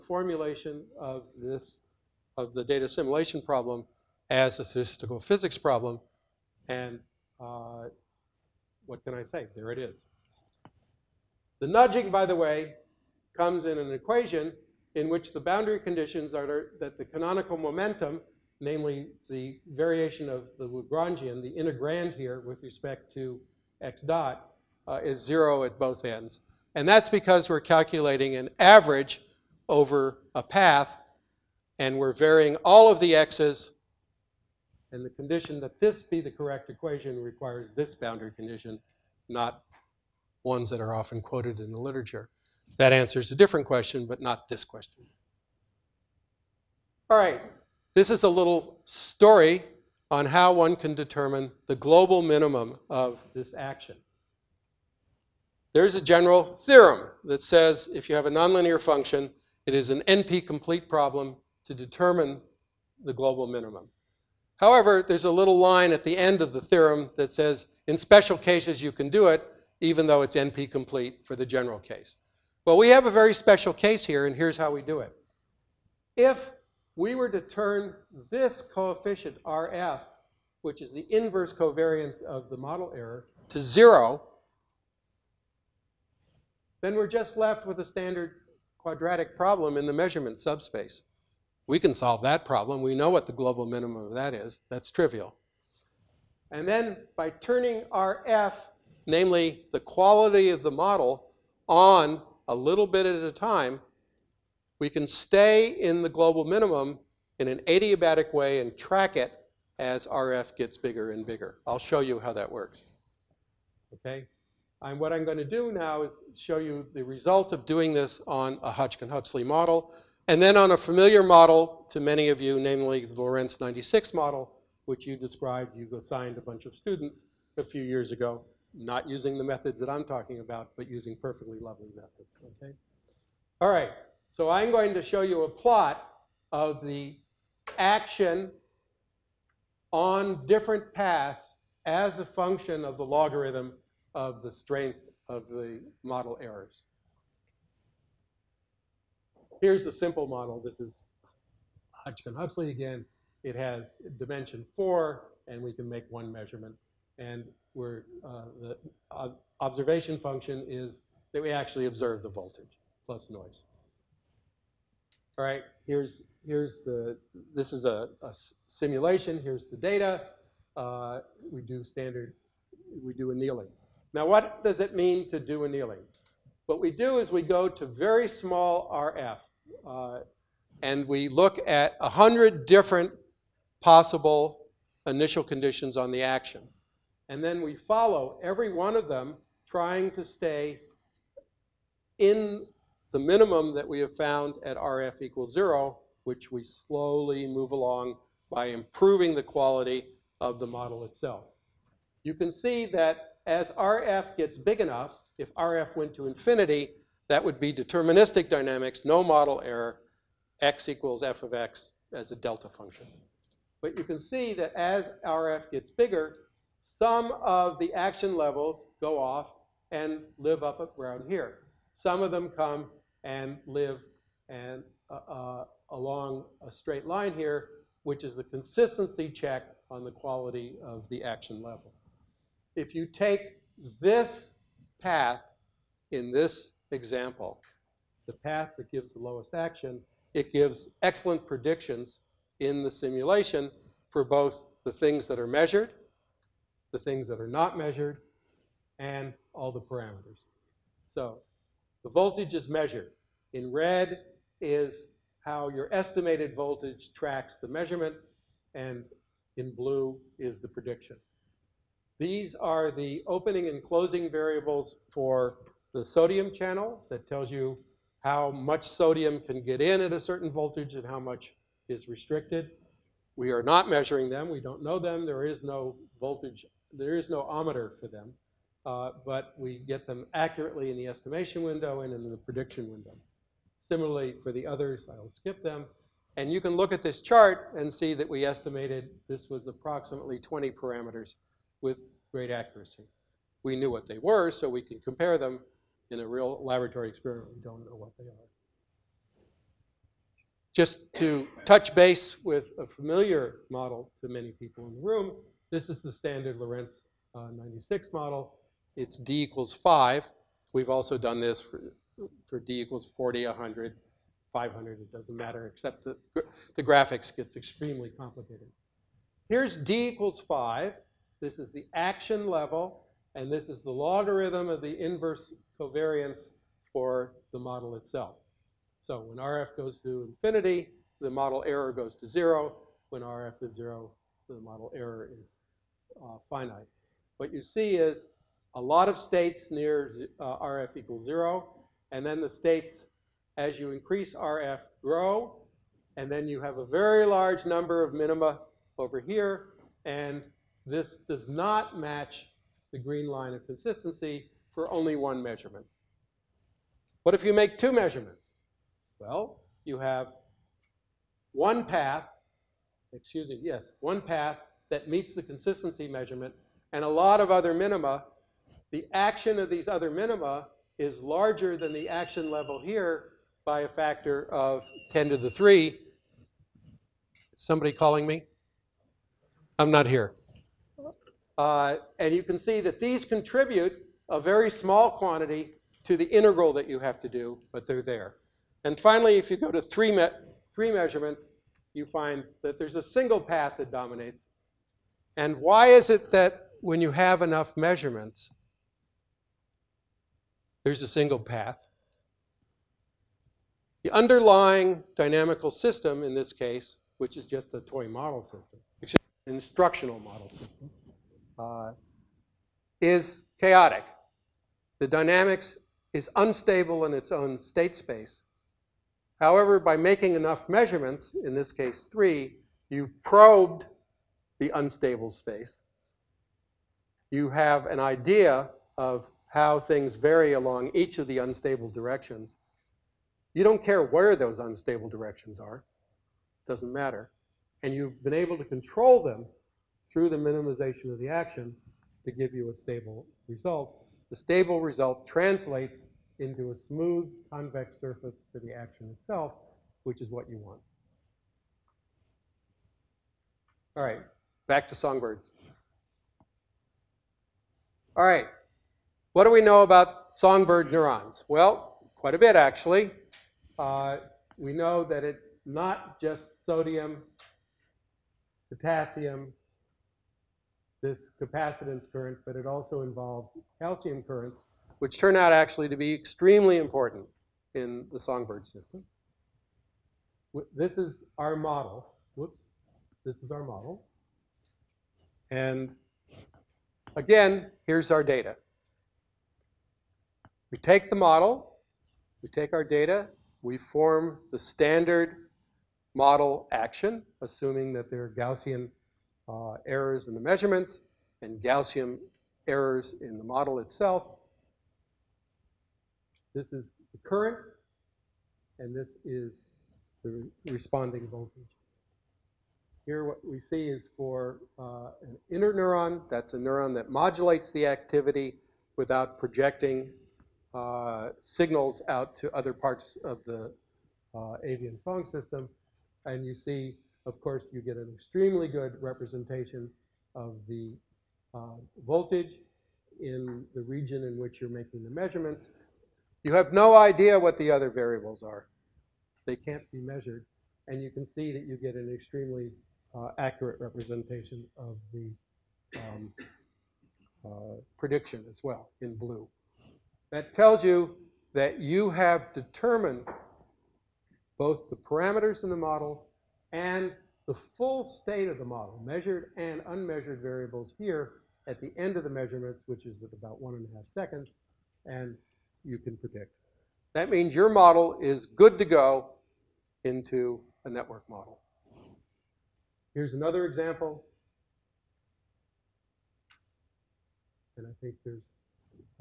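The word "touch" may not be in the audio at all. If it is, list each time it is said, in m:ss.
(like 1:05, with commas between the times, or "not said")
5:01.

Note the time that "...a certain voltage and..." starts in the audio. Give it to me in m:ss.
4:30.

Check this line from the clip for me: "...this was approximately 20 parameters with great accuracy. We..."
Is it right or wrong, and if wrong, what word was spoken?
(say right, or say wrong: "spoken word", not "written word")
right.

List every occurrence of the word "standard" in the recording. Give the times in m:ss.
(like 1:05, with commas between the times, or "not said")
1:27, 2:51, 5:06, 8:14.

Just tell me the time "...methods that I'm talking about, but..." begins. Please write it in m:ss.
2:09.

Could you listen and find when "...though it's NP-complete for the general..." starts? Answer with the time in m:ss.
1:10.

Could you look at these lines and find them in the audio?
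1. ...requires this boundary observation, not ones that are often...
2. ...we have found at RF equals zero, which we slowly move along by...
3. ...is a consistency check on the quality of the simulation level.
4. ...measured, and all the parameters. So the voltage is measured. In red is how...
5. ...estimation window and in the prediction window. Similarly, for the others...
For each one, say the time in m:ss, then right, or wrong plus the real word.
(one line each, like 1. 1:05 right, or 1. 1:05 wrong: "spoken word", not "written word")
1. 0:37 wrong: "condition", not "observation"
2. 3:13 right
3. 3:48 wrong: "action", not "simulation"
4. 4:07 right
5. 4:41 right.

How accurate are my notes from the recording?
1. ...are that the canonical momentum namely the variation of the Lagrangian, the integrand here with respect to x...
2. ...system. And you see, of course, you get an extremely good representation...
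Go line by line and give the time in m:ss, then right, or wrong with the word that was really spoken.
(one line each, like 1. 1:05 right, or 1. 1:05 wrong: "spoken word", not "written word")
1. 0:16 right
2. 8:45 right.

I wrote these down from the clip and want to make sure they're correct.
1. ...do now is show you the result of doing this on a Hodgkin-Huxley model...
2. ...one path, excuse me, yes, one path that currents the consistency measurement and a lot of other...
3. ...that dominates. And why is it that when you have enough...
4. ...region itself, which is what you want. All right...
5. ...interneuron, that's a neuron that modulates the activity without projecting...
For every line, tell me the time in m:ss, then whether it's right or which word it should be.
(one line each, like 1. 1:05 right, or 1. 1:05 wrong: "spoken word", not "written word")
1. 1:55 right
2. 6:01 wrong: "meets", not "currents"
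3. 6:33 right
4. 7:28 wrong: "action", not "region"
5. 8:35 right.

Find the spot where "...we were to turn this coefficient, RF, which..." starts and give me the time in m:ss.
1:16.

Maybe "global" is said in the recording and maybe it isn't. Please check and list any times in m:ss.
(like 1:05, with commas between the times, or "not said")
0:51, 1:03, 1:33, 1:46.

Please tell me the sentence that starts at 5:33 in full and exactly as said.
When RF is 0, the model error is uh, finite.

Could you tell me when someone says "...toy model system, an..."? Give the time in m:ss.
6:47.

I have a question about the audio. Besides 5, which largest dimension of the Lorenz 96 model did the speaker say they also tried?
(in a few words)
500.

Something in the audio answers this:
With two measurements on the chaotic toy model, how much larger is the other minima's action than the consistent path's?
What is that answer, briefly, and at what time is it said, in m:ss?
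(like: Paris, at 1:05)
10 to the 3, at 6:15.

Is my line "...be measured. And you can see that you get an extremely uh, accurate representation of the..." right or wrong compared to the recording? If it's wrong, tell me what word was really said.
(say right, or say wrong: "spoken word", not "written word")
right.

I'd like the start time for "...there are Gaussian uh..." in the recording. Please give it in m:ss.
8:18.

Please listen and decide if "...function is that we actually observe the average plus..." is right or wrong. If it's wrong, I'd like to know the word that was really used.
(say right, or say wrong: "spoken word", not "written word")
wrong: "voltage", not "average".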